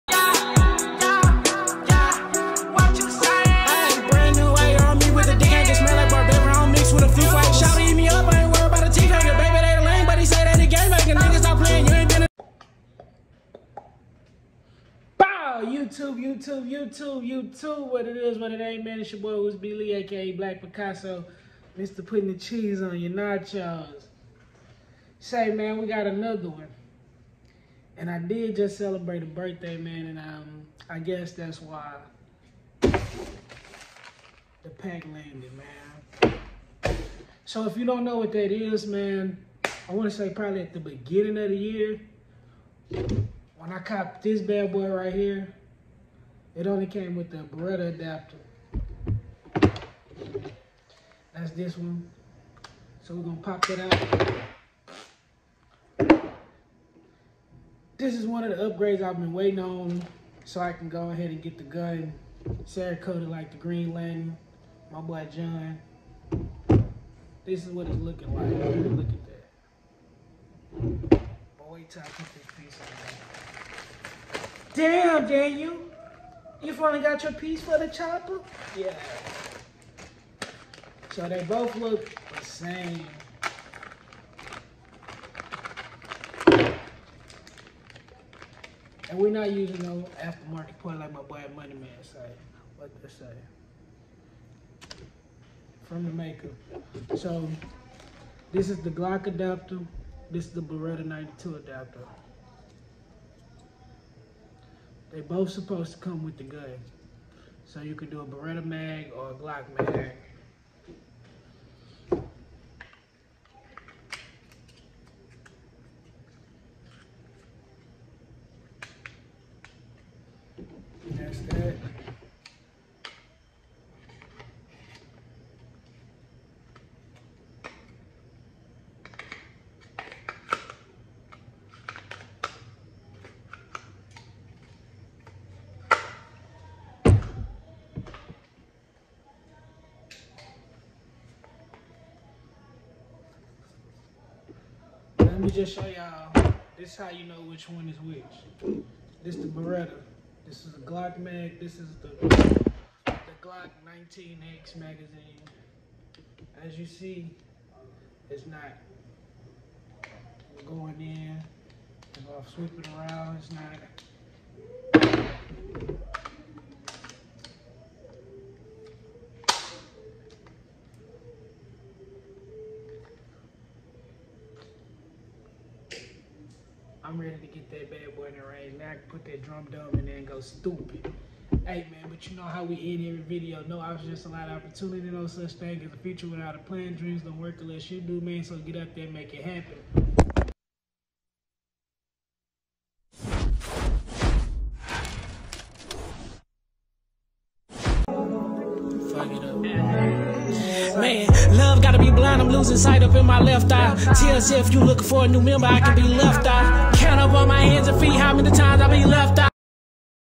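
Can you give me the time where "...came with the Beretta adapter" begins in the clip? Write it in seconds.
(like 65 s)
46 s.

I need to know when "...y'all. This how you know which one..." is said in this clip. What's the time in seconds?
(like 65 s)
145 s.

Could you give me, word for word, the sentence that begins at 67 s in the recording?
This is what it's looking like.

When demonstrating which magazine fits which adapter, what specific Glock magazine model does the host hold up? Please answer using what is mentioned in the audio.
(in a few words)
Glock 19X.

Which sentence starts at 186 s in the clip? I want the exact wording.
Dreams don't work unless you do, man.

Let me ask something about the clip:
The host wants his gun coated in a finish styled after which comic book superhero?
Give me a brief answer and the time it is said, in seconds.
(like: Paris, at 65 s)
Green Lantern, at 63 s.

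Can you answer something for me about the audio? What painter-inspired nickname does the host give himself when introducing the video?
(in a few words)
Black Picasso.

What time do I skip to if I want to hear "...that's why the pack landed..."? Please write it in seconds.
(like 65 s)
31 s.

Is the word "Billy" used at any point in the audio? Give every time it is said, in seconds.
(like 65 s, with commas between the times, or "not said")
19 s.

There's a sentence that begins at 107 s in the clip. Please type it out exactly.
So you can do a Beretta mag or a Glock mag.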